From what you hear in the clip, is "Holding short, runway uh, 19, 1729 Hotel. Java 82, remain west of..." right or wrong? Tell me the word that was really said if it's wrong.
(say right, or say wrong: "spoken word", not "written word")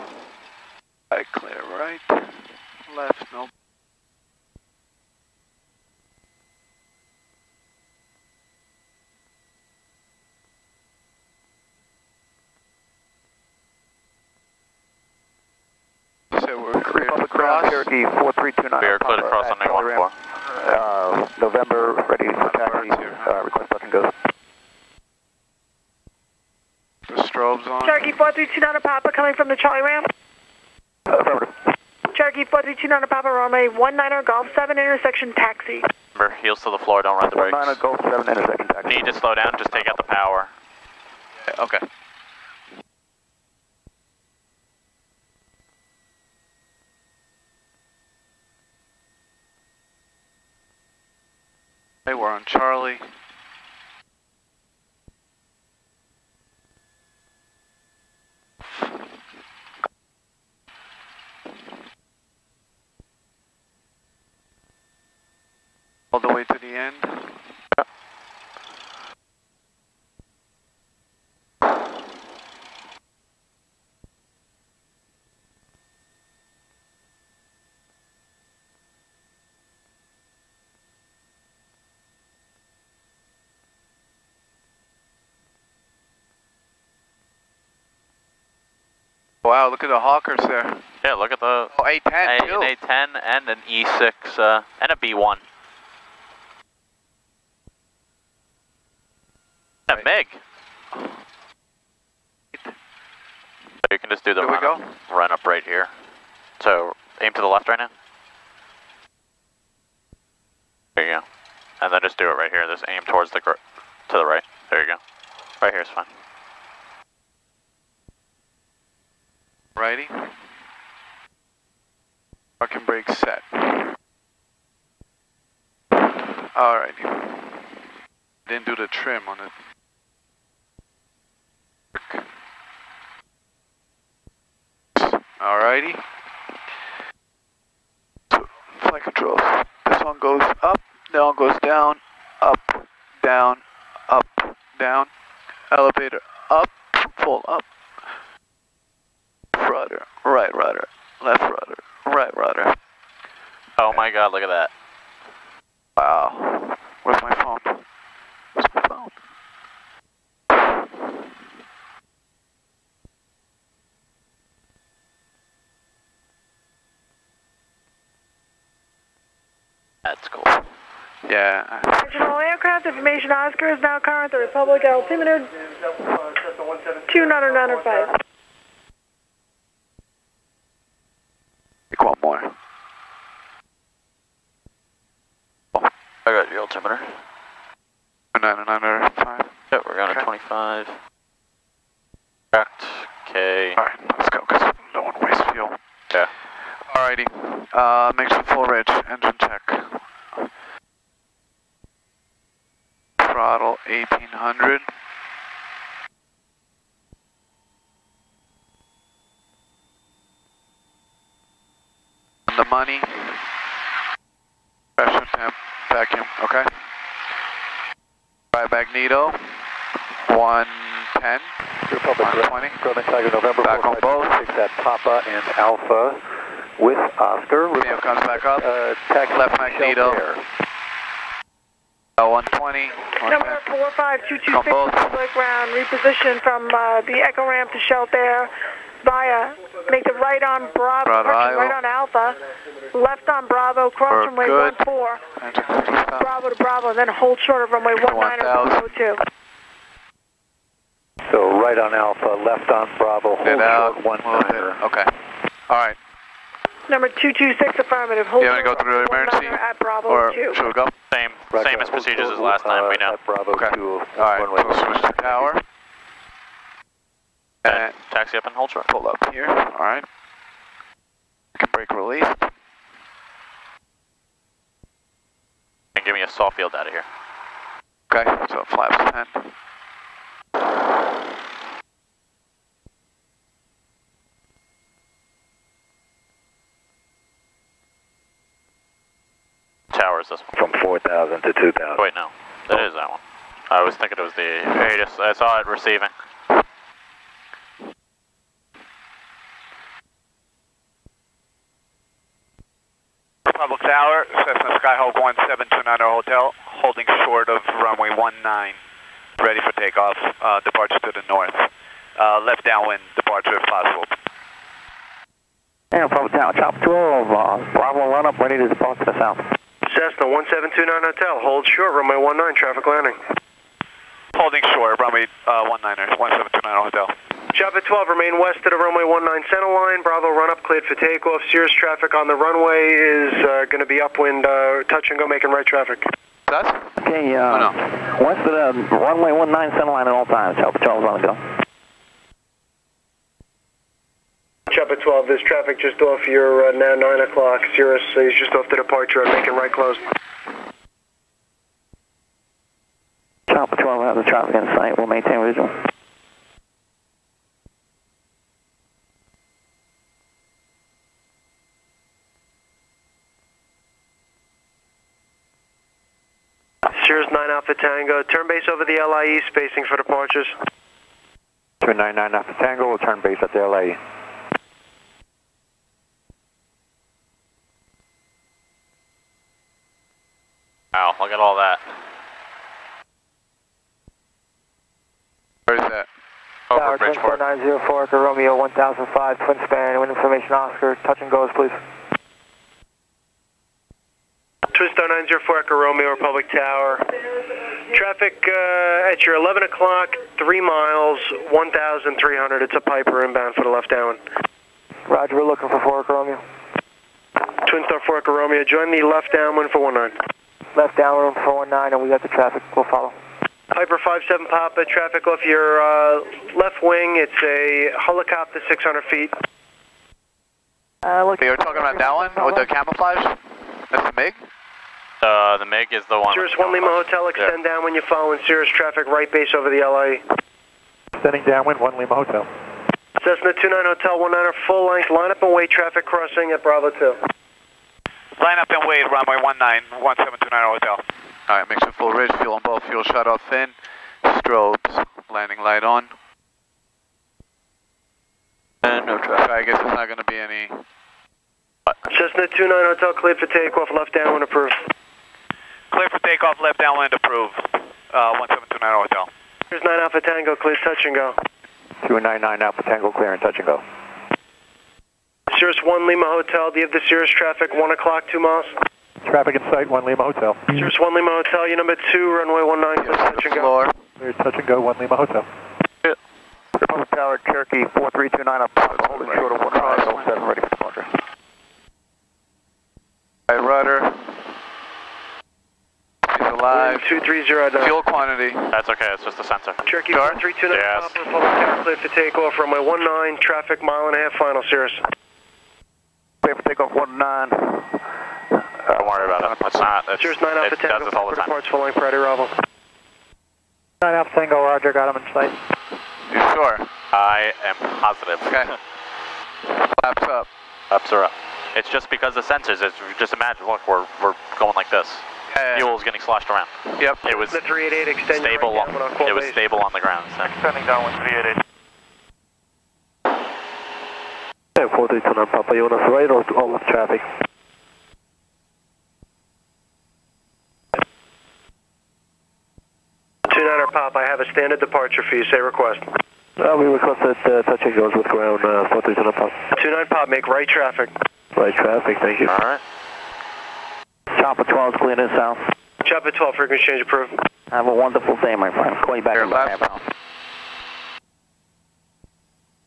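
wrong: "12", not "82".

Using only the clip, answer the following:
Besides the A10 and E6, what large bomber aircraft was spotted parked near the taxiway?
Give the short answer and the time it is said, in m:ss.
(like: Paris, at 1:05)
B1, at 1:34.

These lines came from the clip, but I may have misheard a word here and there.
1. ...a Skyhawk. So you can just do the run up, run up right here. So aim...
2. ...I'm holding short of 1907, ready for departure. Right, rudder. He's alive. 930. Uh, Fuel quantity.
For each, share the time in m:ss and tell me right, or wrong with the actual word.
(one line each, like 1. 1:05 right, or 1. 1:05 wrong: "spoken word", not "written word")
1. 1:40 wrong: "MiG", not "Skyhawk"
2. 7:58 wrong: "230", not "930".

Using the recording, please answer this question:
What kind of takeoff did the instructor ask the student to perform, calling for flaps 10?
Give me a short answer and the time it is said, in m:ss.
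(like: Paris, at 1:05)
soft field, at 4:36.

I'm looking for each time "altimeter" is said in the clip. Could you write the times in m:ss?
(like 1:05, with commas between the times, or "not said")
2:54, 3:06.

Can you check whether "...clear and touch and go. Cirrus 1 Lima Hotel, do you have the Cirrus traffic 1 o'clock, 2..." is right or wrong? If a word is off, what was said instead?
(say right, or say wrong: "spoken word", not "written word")
right.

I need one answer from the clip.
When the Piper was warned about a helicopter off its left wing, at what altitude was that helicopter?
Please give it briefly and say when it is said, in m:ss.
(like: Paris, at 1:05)
600 feet, at 6:58.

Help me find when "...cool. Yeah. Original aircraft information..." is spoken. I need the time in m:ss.
2:50.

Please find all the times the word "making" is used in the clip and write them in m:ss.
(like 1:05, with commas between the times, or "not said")
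5:35, 5:49.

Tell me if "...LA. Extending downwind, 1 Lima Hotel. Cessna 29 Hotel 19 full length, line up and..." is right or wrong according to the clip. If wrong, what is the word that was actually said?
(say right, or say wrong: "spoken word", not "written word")
right.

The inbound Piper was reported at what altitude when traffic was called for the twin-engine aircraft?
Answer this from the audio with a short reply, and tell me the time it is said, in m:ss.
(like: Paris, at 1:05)
1,300, at 6:41.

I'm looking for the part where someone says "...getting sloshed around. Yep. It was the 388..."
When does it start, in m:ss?
8:36.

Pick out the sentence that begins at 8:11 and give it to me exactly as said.
Republic Tower, cleared to take off, runway 19, traffic mile and a half, final, Cirrus.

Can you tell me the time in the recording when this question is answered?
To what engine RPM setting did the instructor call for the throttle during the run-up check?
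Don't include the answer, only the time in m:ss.
3:23.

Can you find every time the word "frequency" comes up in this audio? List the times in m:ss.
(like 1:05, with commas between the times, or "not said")
9:06.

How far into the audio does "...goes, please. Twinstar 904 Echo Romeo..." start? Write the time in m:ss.
6:31.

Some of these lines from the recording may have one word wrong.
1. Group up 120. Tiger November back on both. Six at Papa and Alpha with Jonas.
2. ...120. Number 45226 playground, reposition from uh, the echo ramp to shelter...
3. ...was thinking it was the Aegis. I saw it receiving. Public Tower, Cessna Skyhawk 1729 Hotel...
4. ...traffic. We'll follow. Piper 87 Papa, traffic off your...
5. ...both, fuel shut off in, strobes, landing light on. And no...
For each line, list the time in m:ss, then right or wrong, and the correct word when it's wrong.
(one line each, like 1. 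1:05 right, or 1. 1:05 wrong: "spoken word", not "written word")
1. 3:41 wrong: "Oscar", not "Jonas"
2. 3:52 right
3. 4:53 right
4. 6:52 wrong: "57", not "87"
5. 7:22 right.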